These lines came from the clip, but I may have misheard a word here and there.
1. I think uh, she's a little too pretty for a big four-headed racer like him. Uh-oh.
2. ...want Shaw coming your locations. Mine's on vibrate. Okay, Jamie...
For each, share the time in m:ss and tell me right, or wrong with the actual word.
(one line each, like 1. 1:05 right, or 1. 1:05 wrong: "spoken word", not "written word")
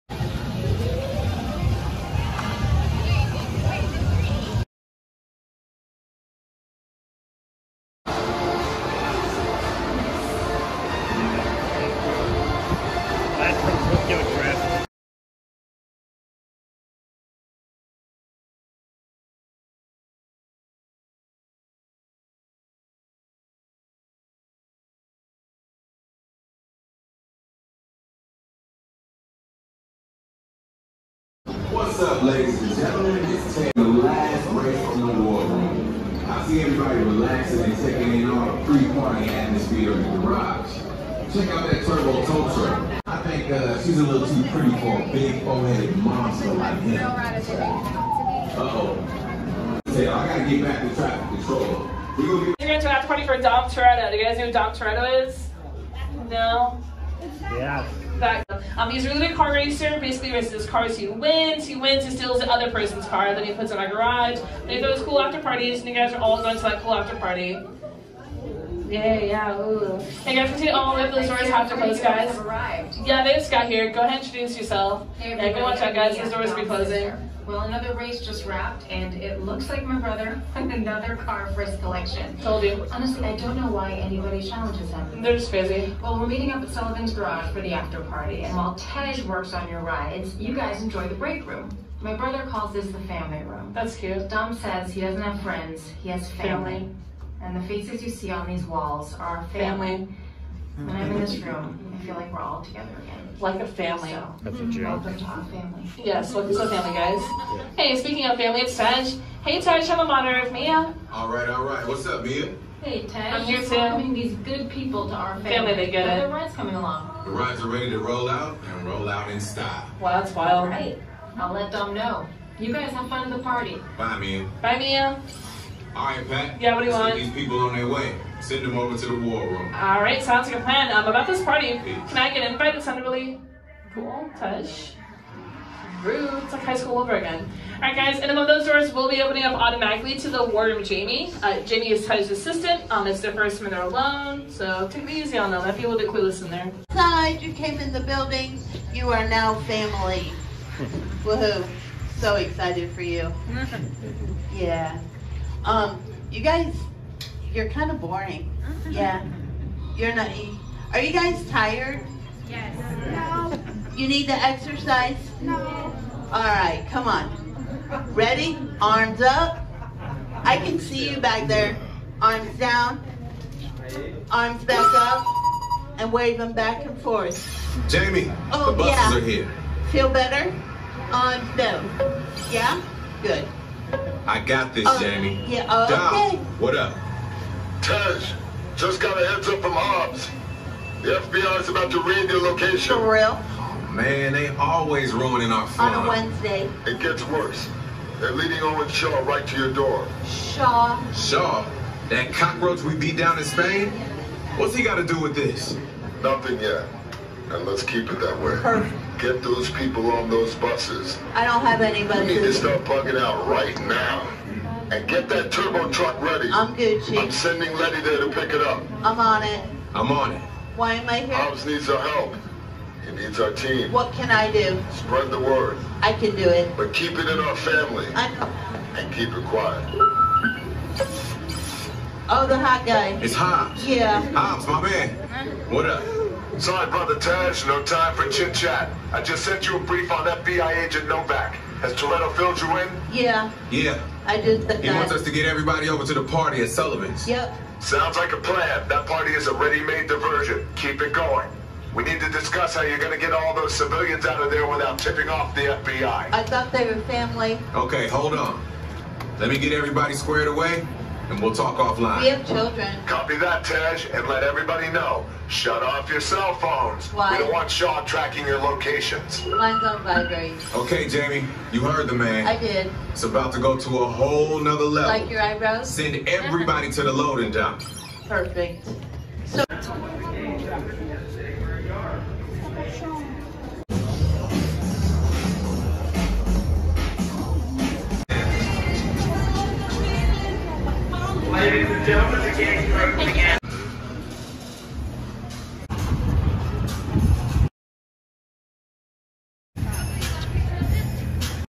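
1. 0:43 wrong: "monster", not "racer"
2. 4:27 wrong: "tracking", not "coming".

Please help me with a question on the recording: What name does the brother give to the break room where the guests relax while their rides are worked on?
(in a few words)
the family room.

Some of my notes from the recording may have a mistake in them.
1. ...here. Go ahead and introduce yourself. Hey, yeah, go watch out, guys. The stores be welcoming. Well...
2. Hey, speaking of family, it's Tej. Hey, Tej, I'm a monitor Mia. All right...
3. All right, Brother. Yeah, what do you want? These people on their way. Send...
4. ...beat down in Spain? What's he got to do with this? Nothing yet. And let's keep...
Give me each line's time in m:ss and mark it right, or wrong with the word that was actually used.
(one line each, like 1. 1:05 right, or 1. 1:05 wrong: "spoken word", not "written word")
1. 1:13 wrong: "closing", not "welcoming"
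2. 1:47 right
3. 2:05 wrong: "Pat", not "Brother"
4. 3:22 right.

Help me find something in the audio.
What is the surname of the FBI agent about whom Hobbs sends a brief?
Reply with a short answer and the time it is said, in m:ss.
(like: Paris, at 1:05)
Novak, at 4:01.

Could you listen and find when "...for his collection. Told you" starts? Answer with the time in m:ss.
1:21.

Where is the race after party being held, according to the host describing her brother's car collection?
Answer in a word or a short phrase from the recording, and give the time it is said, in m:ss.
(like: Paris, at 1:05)
Sullivan's Garage, at 1:26.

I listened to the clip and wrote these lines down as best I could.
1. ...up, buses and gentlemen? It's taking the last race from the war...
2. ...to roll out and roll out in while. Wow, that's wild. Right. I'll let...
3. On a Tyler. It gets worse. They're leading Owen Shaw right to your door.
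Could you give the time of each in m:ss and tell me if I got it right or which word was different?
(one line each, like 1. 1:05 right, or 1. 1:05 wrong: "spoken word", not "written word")
1. 0:32 wrong: "ladies", not "buses"
2. 1:57 wrong: "style", not "while"
3. 3:15 wrong: "Wednesday", not "Tyler".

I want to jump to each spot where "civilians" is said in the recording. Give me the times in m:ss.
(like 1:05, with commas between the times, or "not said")
4:13.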